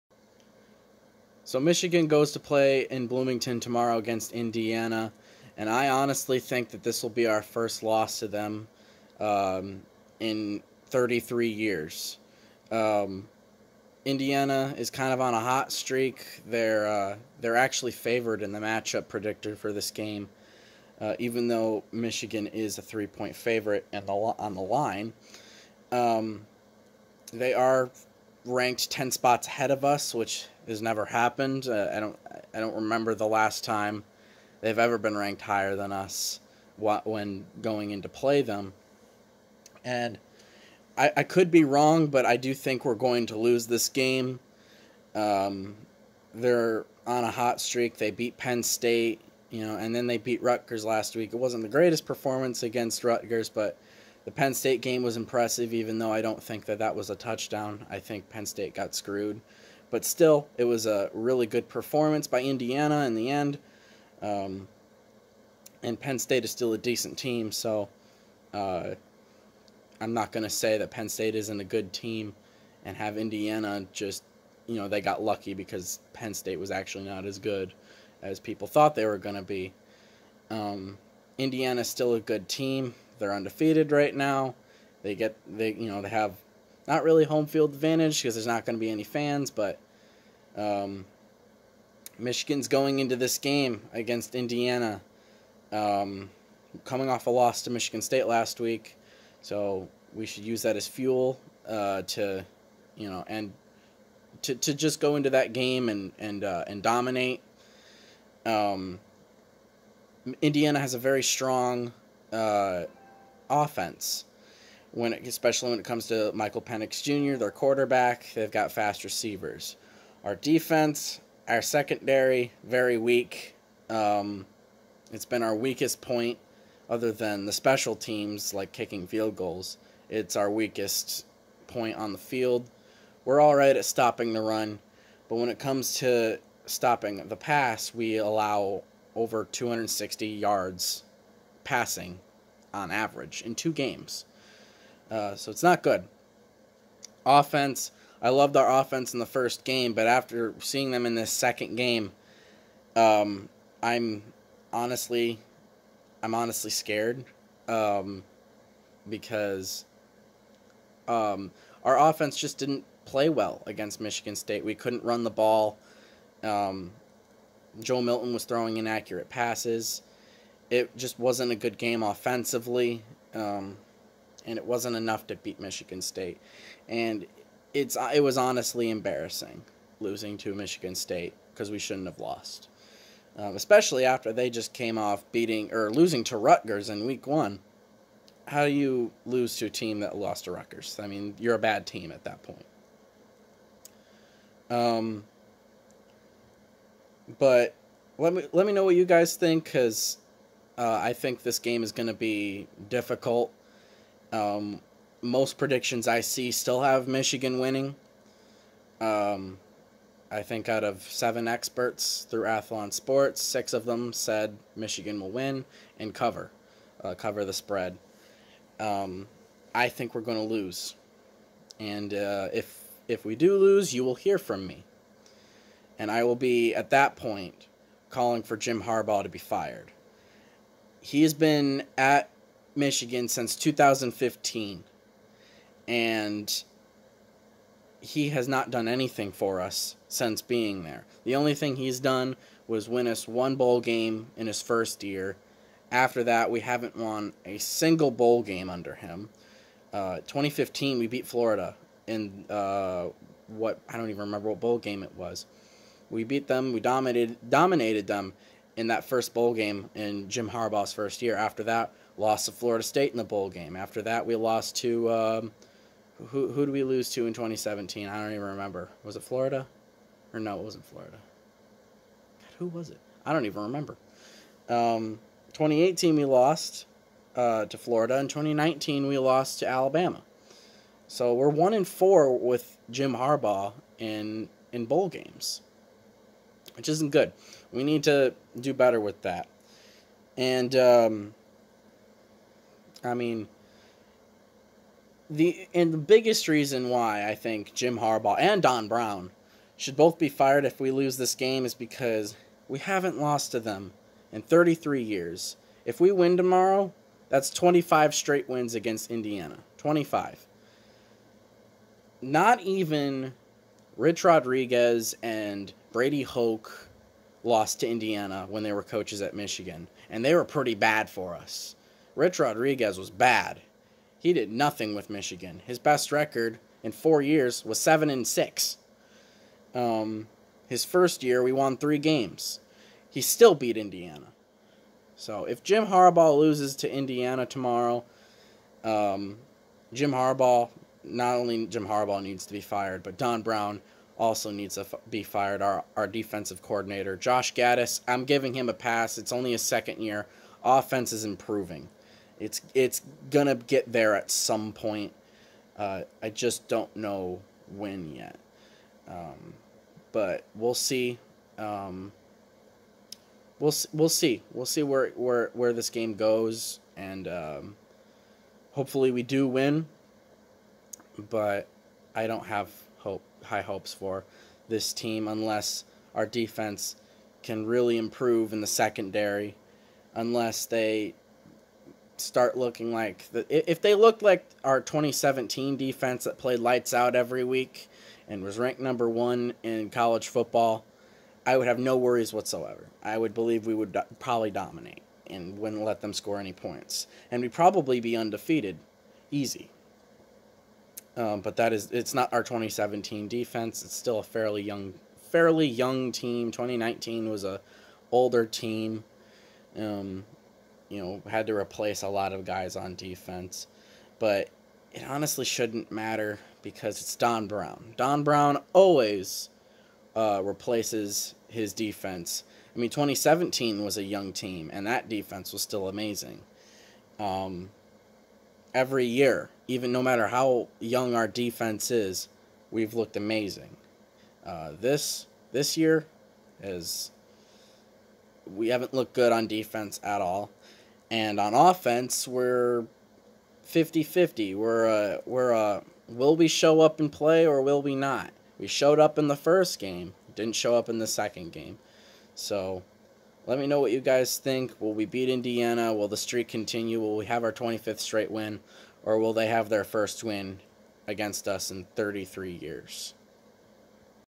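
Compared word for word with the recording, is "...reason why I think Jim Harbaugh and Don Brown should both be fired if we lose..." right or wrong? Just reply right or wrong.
right.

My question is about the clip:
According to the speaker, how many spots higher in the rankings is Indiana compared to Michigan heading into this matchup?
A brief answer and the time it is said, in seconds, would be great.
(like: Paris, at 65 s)
10, at 28 s.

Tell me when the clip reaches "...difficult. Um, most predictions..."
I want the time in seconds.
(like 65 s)
202 s.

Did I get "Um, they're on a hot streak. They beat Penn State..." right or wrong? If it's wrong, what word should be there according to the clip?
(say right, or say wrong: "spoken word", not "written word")
right.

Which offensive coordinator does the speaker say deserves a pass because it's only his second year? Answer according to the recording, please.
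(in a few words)
Josh Gattis.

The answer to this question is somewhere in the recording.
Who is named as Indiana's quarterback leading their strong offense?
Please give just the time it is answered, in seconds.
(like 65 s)
116 s.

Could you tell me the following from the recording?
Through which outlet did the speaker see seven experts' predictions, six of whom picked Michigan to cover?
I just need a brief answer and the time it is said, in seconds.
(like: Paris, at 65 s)
Athlon Sports, at 212 s.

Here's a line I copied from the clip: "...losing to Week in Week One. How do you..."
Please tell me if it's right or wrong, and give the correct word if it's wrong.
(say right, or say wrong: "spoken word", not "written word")
wrong: "Rutgers", not "Week".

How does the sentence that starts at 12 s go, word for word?
Um, Indiana is kind of on a hot streak.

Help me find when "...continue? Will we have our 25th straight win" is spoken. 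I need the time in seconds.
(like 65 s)
456 s.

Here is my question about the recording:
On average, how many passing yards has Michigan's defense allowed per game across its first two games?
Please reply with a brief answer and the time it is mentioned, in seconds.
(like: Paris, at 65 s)
Over 260, at 139 s.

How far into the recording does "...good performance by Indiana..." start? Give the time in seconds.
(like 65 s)
61 s.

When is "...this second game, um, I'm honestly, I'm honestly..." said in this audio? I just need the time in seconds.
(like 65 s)
151 s.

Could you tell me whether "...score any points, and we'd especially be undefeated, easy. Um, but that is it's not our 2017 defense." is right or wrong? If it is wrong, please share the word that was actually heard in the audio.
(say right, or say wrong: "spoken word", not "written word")
wrong: "probably", not "especially".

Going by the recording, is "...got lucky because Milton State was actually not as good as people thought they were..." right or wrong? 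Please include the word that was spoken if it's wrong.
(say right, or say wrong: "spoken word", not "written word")
wrong: "Penn", not "Milton".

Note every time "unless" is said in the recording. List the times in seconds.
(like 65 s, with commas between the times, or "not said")
375 s, 380 s.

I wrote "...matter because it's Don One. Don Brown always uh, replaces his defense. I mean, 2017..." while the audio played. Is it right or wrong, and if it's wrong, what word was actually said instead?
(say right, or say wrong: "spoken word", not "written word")
wrong: "Brown", not "One".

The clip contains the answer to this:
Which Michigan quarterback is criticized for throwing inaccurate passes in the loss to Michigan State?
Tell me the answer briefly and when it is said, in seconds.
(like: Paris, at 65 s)
Joe Milton, at 167 s.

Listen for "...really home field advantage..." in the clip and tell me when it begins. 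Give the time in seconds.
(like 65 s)
87 s.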